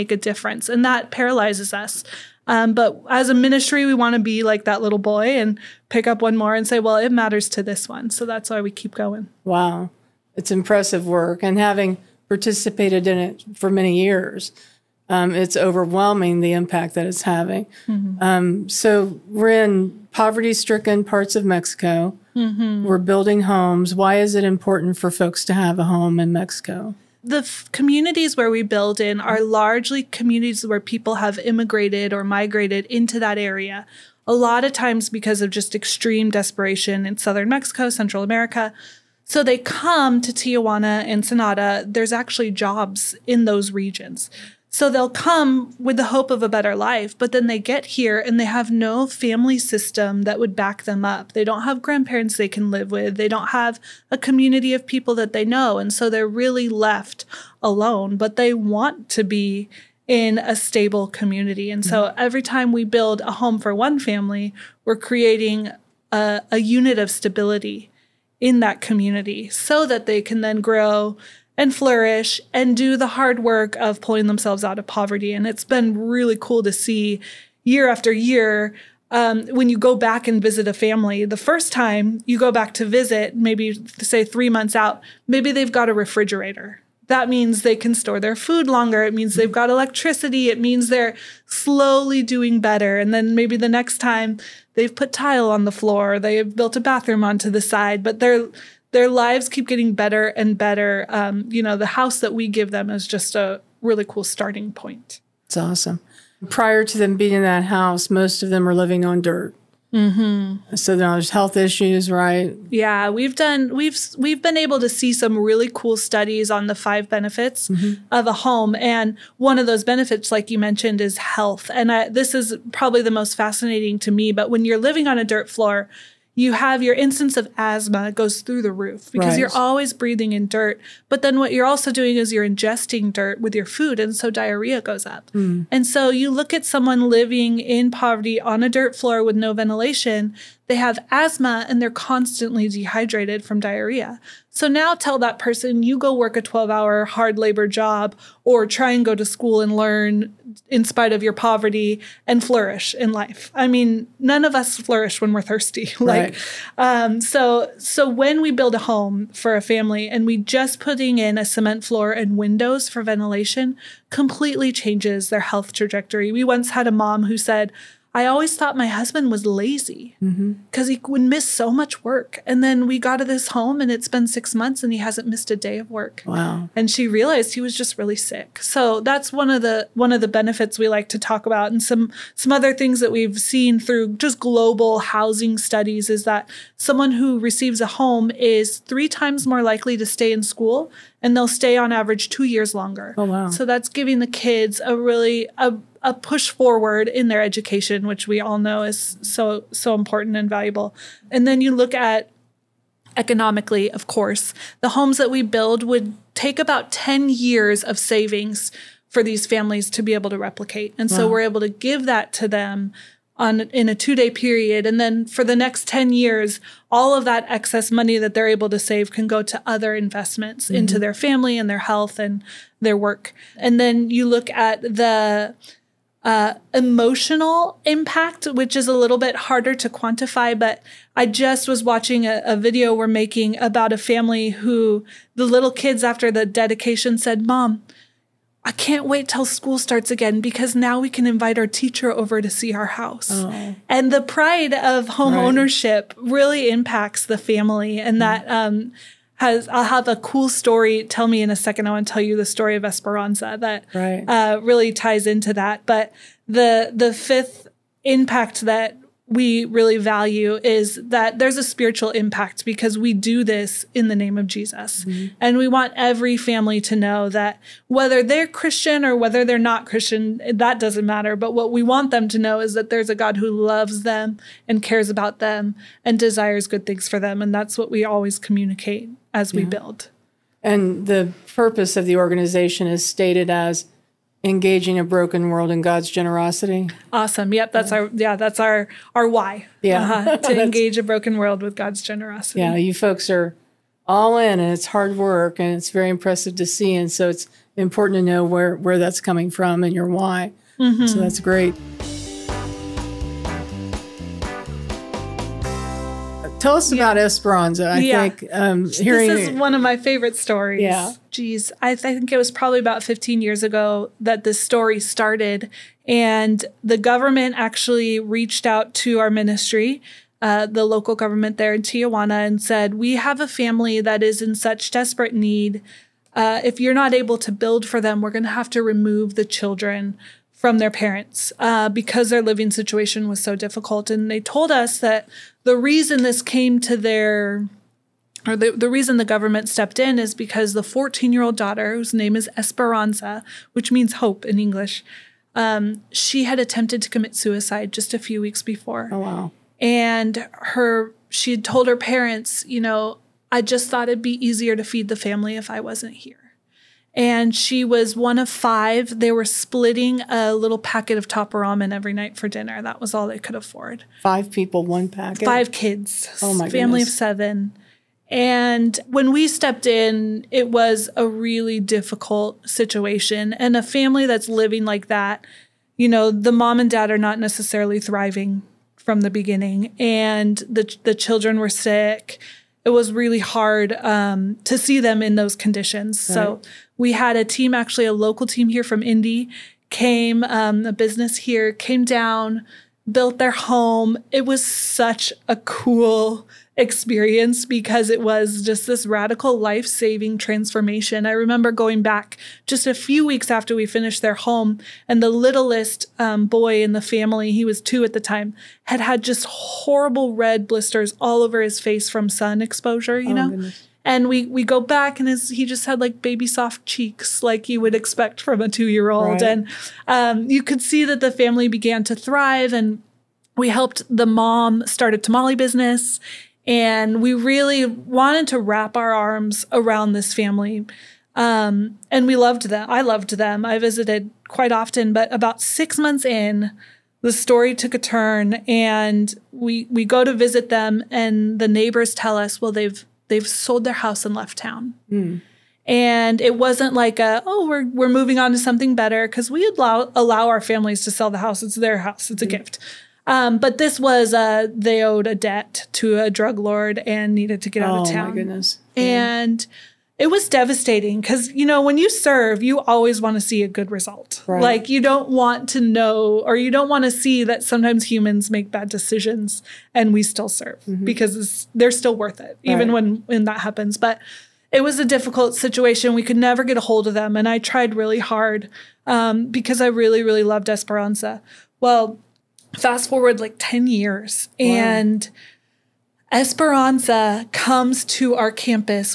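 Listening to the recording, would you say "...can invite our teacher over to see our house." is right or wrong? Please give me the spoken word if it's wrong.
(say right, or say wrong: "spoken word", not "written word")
right.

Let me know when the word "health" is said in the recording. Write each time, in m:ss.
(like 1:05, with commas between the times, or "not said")
1:51, 2:01, 2:45, 3:41.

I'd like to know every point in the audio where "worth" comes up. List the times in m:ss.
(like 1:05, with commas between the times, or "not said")
7:52.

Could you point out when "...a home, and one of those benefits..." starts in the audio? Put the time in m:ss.
1:58.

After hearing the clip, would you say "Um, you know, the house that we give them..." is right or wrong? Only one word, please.
right.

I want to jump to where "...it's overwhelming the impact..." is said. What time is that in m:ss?
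0:15.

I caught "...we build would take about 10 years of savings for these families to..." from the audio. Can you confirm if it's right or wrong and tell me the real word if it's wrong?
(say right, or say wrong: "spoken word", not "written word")
right.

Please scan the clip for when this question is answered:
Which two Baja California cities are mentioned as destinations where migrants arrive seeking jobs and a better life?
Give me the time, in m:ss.
0:40.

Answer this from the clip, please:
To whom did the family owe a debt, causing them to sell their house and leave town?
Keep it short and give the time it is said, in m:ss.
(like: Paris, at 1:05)
a drug lord, at 7:36.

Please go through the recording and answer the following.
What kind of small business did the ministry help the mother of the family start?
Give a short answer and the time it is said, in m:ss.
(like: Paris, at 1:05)
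tamale business, at 7:05.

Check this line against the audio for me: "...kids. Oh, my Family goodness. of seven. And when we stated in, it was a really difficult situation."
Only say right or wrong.
wrong.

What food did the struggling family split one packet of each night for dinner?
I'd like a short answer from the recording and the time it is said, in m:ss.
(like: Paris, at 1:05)
top ramen, at 6:01.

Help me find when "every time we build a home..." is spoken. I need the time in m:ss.
1:02.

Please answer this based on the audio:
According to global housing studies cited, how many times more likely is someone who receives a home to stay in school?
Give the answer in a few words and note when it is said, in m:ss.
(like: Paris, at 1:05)
3 times, at 3:08.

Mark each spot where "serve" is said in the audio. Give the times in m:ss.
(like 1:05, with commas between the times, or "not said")
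7:42, 7:50.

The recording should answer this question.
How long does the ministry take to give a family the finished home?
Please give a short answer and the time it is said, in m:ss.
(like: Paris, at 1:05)
2 days, at 3:33.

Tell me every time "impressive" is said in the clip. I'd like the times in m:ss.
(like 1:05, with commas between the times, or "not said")
0:10, 4:56.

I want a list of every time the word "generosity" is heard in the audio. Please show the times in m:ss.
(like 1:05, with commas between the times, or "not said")
4:46, 4:52.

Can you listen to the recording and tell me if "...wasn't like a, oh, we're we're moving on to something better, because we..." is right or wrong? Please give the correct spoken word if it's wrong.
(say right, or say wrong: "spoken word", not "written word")
right.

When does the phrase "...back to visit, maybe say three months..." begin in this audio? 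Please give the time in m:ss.
1:22.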